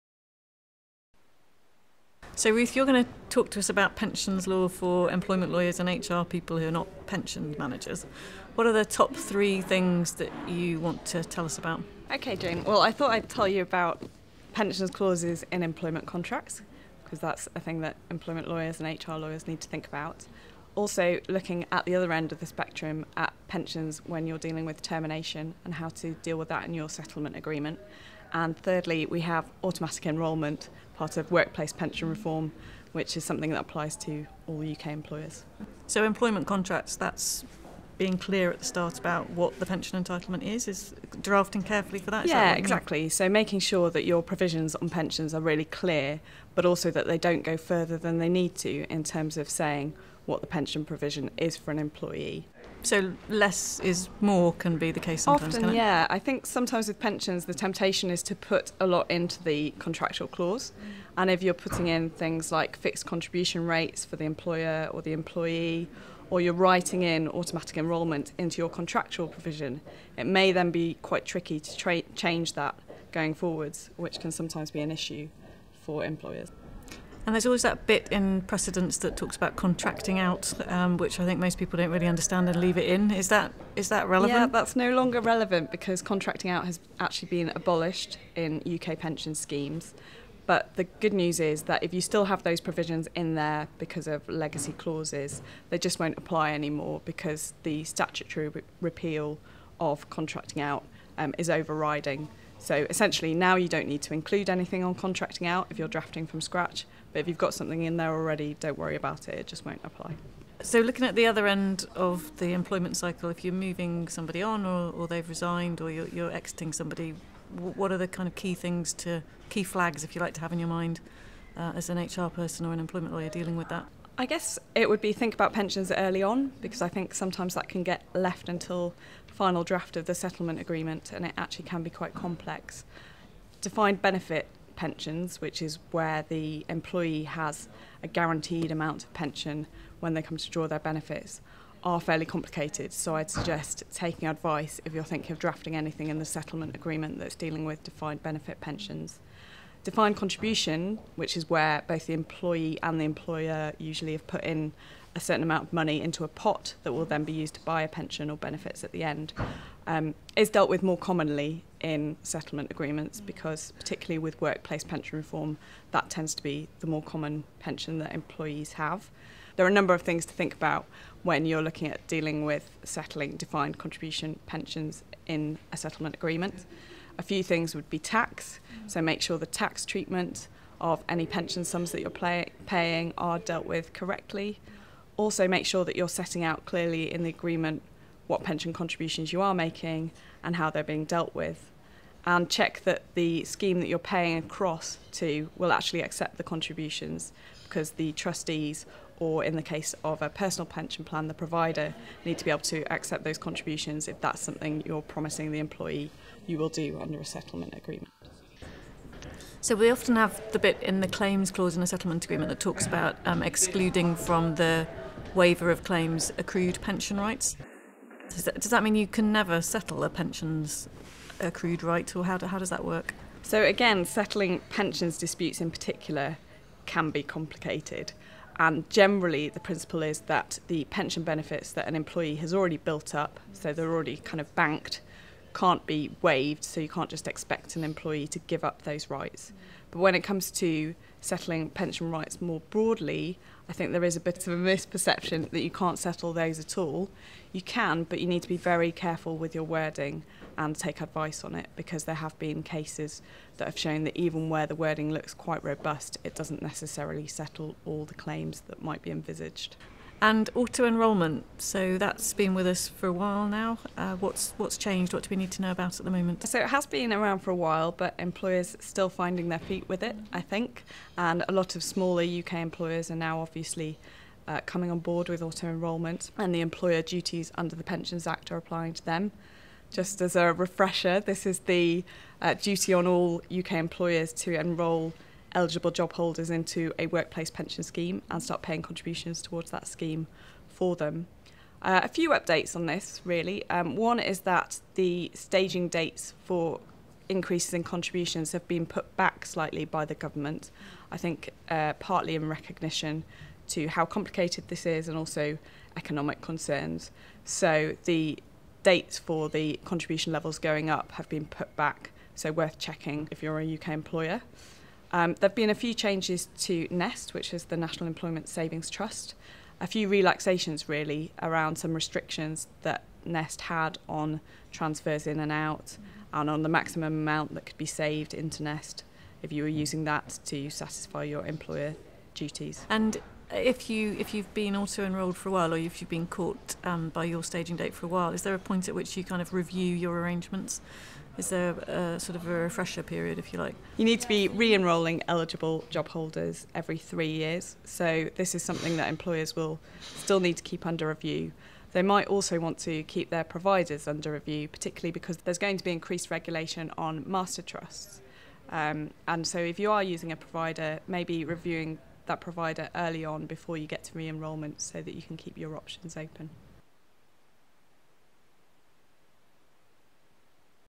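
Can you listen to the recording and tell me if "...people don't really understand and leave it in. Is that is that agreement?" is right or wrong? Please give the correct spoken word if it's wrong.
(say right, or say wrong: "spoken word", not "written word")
wrong: "relevant", not "agreement".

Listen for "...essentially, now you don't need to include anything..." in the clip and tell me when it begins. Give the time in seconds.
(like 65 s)
102 s.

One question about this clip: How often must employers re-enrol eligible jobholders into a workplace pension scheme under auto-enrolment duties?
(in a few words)
Every 3 years.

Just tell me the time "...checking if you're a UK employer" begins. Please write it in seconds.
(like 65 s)
312 s.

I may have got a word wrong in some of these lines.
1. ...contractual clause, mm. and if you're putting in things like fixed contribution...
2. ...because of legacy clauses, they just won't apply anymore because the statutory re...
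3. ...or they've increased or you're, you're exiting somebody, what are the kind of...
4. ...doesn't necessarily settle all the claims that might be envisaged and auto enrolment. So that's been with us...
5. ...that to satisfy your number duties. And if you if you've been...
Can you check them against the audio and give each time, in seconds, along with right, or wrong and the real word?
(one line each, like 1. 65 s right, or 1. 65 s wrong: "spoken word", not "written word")
1. 59 s right
2. 93 s right
3. 114 s wrong: "resigned", not "increased"
4. 256 s right
5. 330 s wrong: "employer", not "number".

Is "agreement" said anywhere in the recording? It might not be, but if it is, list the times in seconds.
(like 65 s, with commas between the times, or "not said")
27 s, 130 s, 146 s, 162 s, 176 s, 187 s, 207 s, 212 s.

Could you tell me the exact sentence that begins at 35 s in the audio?
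So employment contracts, that's being clear at the start about what the pension entitlement is, is drafting carefully for that.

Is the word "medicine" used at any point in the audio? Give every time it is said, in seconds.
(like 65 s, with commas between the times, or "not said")
not said.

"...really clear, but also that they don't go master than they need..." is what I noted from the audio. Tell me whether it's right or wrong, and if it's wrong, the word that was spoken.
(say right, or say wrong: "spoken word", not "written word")
wrong: "further", not "master".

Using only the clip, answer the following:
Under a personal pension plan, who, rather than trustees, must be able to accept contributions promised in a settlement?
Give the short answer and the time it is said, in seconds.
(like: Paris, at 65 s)
The provider, at 201 s.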